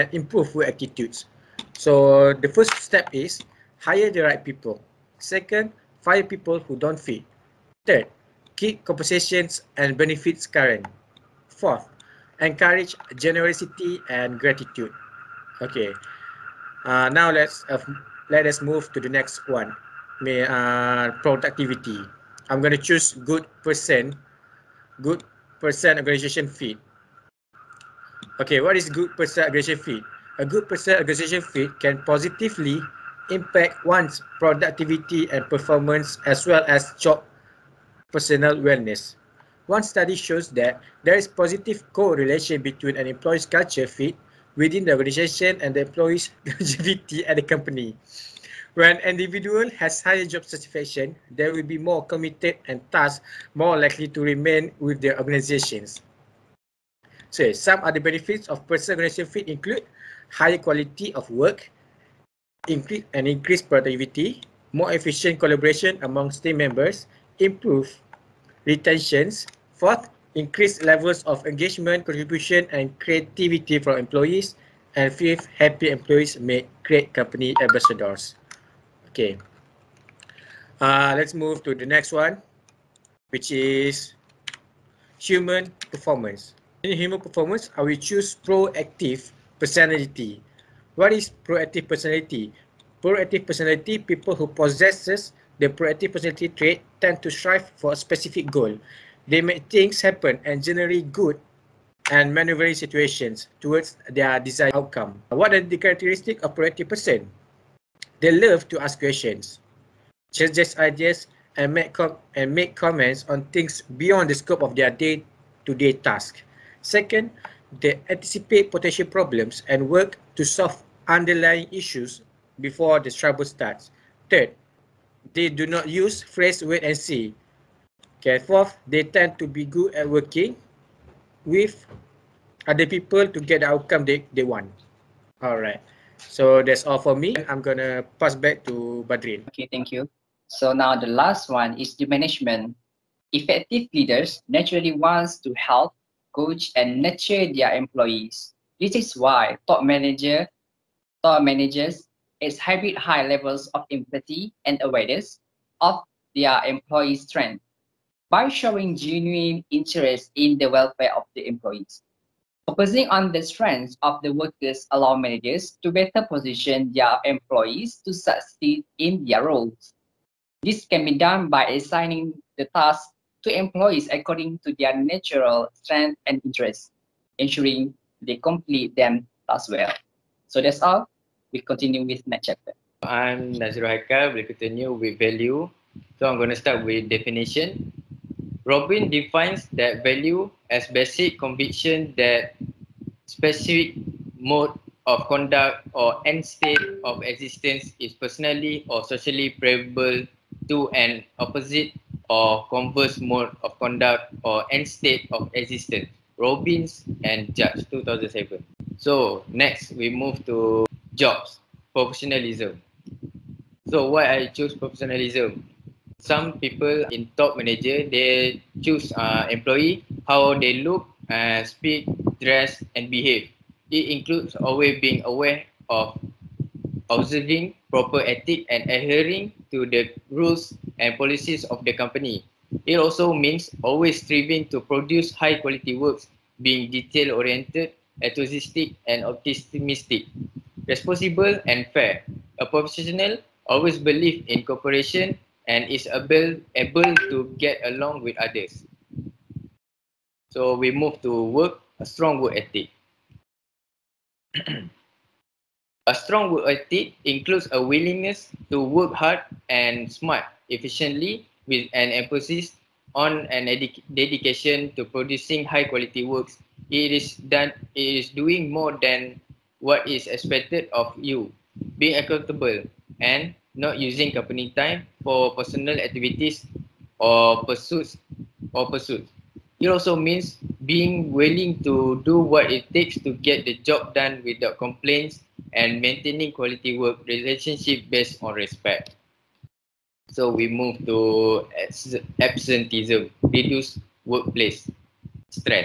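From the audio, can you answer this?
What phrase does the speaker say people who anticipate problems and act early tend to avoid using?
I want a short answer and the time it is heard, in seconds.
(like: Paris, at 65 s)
Wait and see, at 126 s.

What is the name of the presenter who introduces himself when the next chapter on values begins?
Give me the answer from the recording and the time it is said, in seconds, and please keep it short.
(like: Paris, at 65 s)
Nazir Haiqal, at 183 s.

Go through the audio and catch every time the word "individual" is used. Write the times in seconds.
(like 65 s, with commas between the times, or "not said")
49 s.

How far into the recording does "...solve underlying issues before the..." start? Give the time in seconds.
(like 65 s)
120 s.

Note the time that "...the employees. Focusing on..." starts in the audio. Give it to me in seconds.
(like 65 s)
161 s.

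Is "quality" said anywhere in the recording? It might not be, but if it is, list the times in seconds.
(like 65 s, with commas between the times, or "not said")
60 s, 235 s, 265 s, 286 s.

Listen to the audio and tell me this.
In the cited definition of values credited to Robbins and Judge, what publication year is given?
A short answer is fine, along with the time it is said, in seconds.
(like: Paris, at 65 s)
2007, at 207 s.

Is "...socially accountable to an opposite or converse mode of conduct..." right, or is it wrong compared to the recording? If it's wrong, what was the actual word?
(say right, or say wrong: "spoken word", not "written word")
wrong: "preferable", not "accountable".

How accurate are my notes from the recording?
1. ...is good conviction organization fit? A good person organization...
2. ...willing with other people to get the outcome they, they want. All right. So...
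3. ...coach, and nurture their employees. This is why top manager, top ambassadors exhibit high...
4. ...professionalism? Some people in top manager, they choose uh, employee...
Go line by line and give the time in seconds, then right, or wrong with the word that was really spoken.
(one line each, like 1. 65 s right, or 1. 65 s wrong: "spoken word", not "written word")
1. 28 s wrong: "person", not "conviction"
2. 130 s wrong: "working", not "willing"
3. 146 s wrong: "managers", not "ambassadors"
4. 214 s right.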